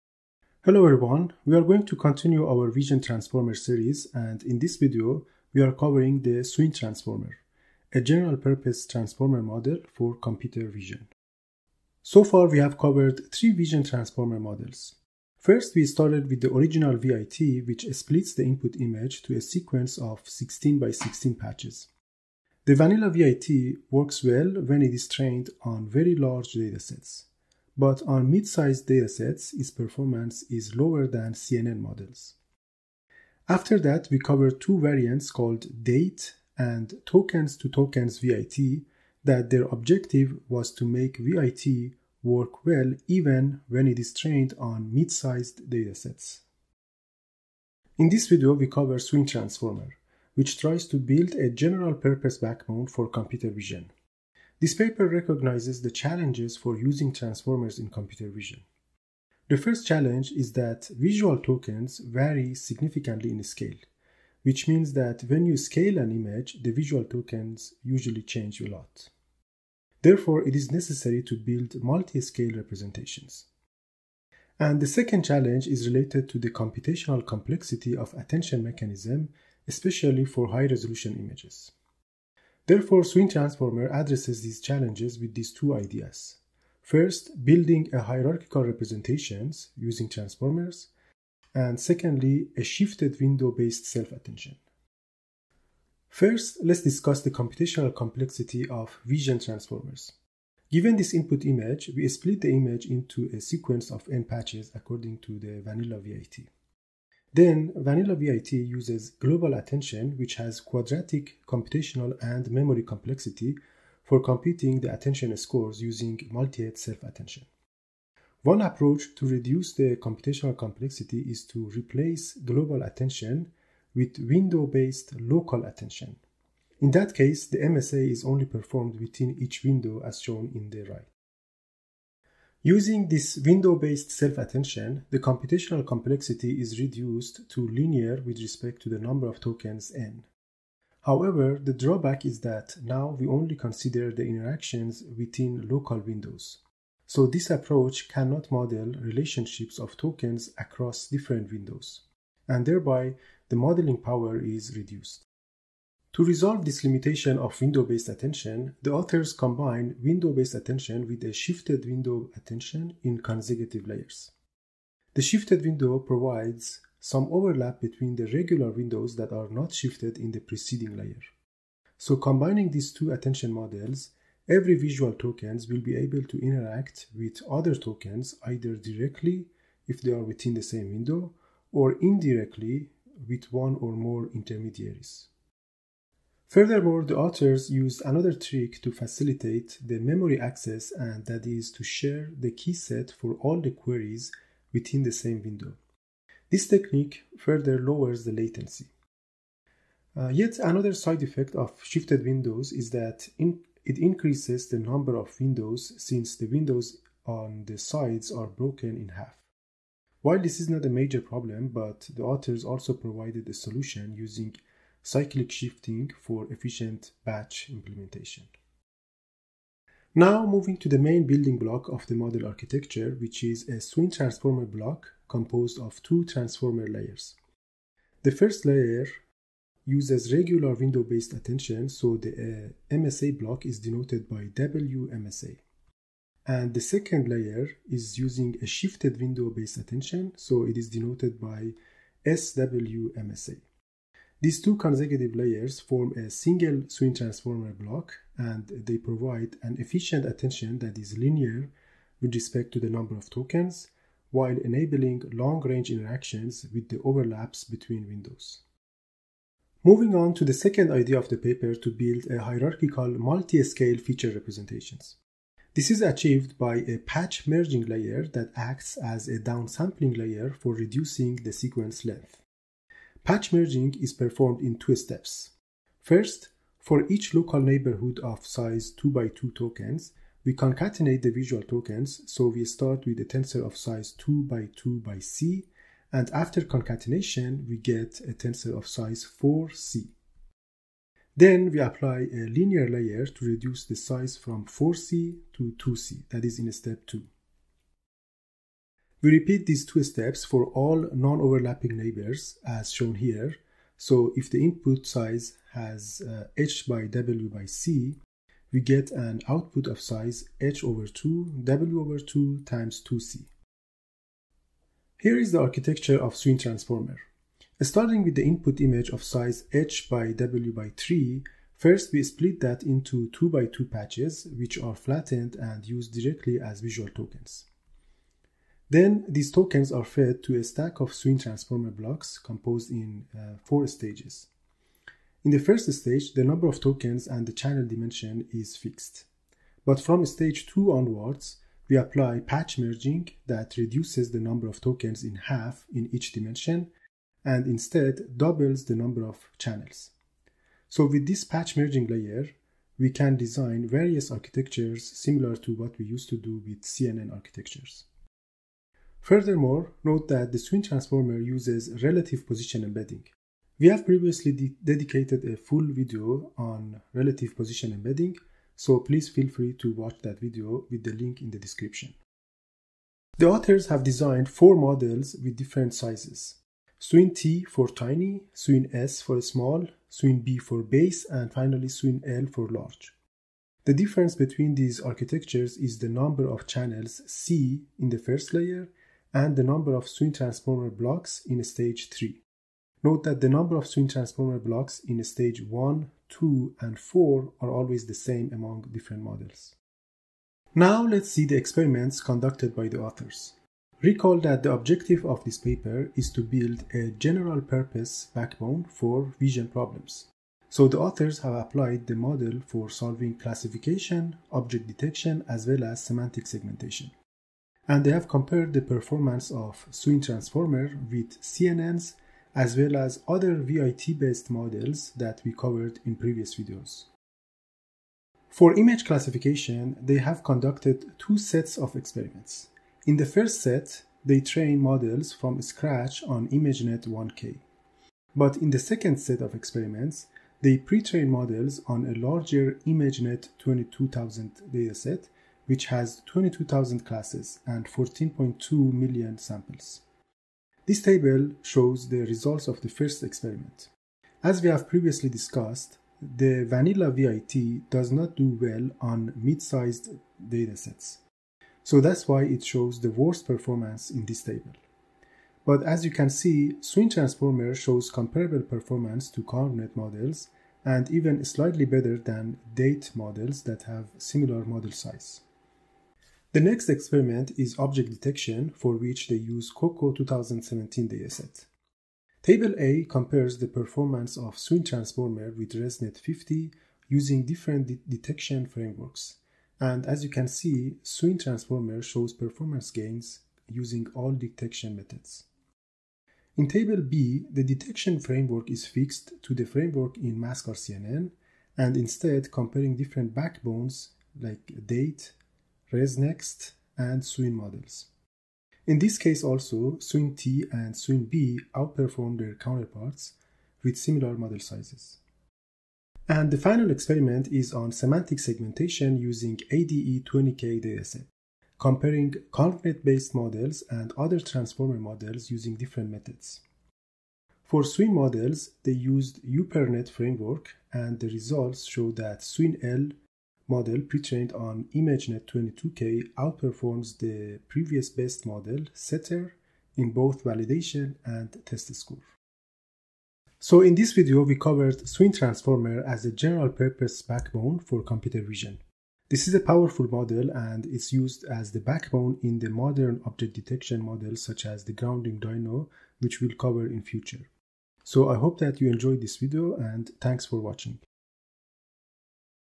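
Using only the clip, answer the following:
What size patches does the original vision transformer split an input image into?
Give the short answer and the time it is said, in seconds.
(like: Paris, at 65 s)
16 by 16, at 20 s.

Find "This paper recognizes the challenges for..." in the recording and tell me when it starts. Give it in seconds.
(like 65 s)
54 s.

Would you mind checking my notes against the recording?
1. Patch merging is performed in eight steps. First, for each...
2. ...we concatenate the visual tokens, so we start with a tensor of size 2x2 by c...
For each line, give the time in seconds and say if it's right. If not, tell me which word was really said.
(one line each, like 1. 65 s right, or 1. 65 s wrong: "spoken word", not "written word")
1. 273 s wrong: "two", not "eight"
2. 280 s right.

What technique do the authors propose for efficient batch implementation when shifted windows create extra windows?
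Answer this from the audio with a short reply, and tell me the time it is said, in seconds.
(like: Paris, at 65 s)
Cyclic shifting, at 215 s.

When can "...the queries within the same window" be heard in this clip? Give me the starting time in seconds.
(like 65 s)
193 s.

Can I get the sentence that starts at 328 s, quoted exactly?
Then these tokens are fed to a stack of Swin transformer blocks composed in uh, four stages.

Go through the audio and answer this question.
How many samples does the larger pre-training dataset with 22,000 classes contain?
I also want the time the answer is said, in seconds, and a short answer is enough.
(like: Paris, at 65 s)
14.2 million, at 447 s.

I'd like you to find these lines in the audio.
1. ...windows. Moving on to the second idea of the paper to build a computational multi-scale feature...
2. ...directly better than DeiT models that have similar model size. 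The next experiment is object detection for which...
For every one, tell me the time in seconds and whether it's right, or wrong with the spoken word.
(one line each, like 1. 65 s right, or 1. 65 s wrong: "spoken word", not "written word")
1. 258 s wrong: "hierarchical", not "computational"
2. 471 s wrong: "slightly", not "directly".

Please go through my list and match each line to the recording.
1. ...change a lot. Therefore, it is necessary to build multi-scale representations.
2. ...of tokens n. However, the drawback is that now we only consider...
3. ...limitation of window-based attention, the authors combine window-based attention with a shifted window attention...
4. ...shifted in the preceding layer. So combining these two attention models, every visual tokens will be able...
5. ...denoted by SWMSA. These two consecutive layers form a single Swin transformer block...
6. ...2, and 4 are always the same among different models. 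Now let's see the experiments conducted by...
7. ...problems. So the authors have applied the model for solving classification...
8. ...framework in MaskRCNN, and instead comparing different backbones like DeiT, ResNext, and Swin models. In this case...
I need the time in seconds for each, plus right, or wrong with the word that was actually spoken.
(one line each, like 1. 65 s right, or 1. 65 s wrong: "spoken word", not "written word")
1. 68 s right
2. 139 s right
3. 156 s right
4. 169 s right
5. 240 s right
6. 396 s right
7. 409 s right
8. 499 s right.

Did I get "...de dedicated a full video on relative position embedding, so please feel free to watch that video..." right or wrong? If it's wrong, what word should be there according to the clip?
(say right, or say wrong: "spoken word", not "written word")
right.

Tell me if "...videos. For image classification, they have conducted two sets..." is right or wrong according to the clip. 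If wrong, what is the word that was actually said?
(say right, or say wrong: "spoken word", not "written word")
right.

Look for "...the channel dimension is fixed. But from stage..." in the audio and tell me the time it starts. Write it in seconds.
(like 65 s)
337 s.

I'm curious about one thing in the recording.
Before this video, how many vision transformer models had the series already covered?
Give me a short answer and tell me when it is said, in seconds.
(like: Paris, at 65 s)
3, at 13 s.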